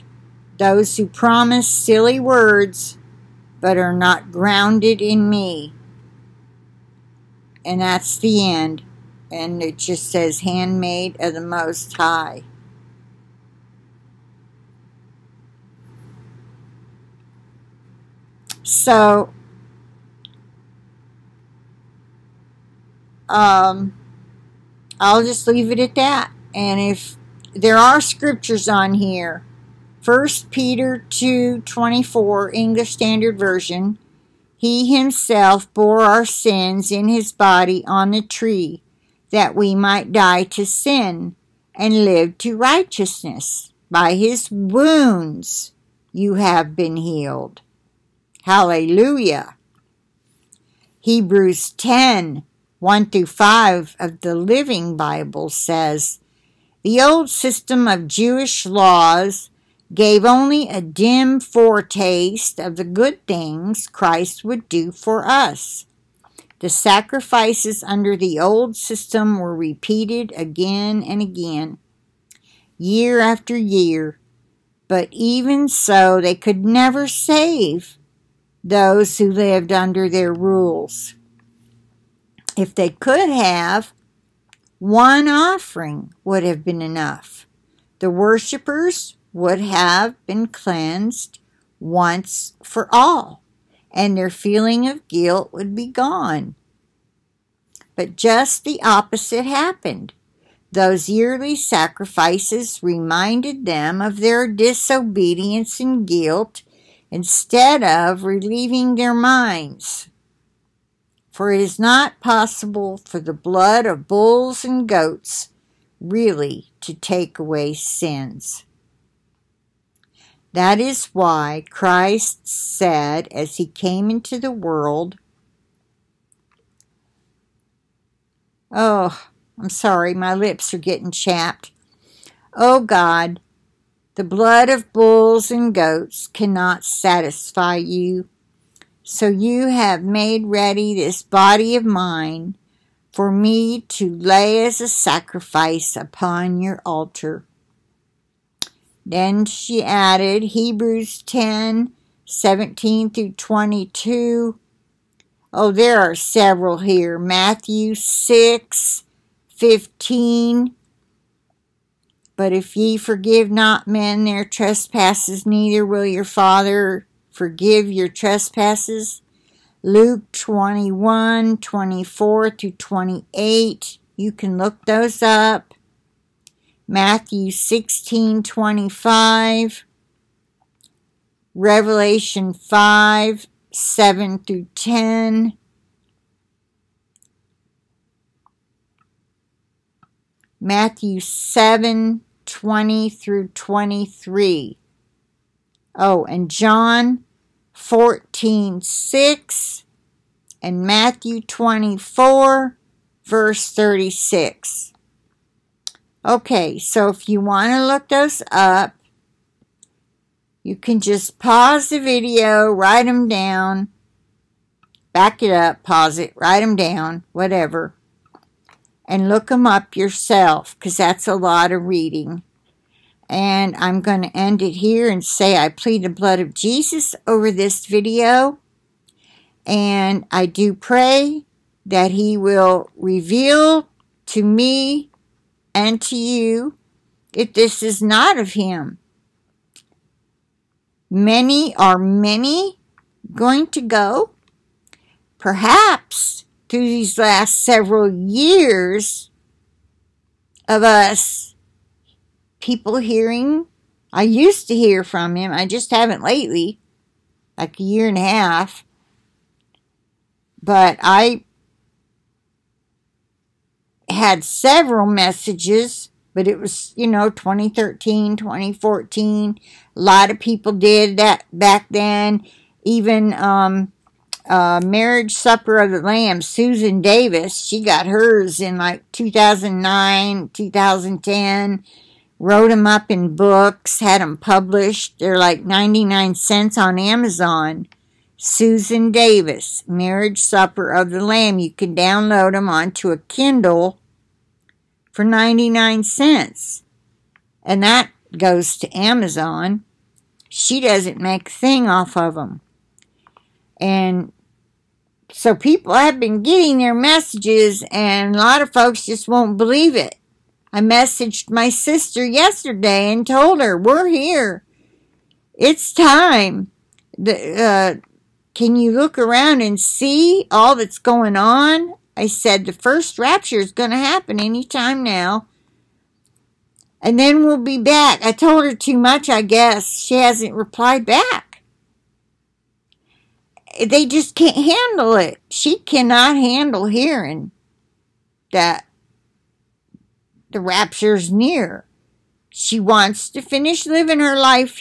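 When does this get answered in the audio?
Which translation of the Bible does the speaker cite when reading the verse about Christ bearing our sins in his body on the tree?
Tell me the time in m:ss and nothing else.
0:32.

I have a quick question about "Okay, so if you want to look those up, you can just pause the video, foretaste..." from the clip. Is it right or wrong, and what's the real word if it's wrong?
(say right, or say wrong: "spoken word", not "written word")
wrong: "write", not "foretaste".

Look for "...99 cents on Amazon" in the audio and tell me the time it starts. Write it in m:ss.
4:45.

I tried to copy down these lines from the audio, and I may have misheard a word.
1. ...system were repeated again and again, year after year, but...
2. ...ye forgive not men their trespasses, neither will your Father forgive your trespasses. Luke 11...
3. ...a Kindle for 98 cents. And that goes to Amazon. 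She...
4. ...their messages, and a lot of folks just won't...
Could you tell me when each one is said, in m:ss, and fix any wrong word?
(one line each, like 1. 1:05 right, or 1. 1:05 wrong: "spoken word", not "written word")
1. 1:08 right
2. 2:42 wrong: "21", not "11"
3. 4:53 wrong: "99", not "98"
4. 5:06 right.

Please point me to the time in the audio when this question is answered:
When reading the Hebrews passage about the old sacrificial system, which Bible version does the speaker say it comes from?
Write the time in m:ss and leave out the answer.
0:54.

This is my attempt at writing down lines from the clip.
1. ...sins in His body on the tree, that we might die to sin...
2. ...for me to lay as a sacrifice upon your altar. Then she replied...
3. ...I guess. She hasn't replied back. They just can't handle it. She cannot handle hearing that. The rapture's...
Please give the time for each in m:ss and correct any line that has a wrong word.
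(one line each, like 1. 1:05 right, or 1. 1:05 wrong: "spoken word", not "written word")
1. 0:36 right
2. 2:23 wrong: "added", not "replied"
3. 5:29 right.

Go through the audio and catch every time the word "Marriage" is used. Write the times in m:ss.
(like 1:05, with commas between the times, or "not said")
4:34, 4:49.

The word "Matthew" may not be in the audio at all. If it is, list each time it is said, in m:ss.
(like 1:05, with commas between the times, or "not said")
2:37, 2:56, 3:10, 3:20.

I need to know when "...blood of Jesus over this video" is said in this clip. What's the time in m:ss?
3:46.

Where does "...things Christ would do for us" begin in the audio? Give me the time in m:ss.
1:03.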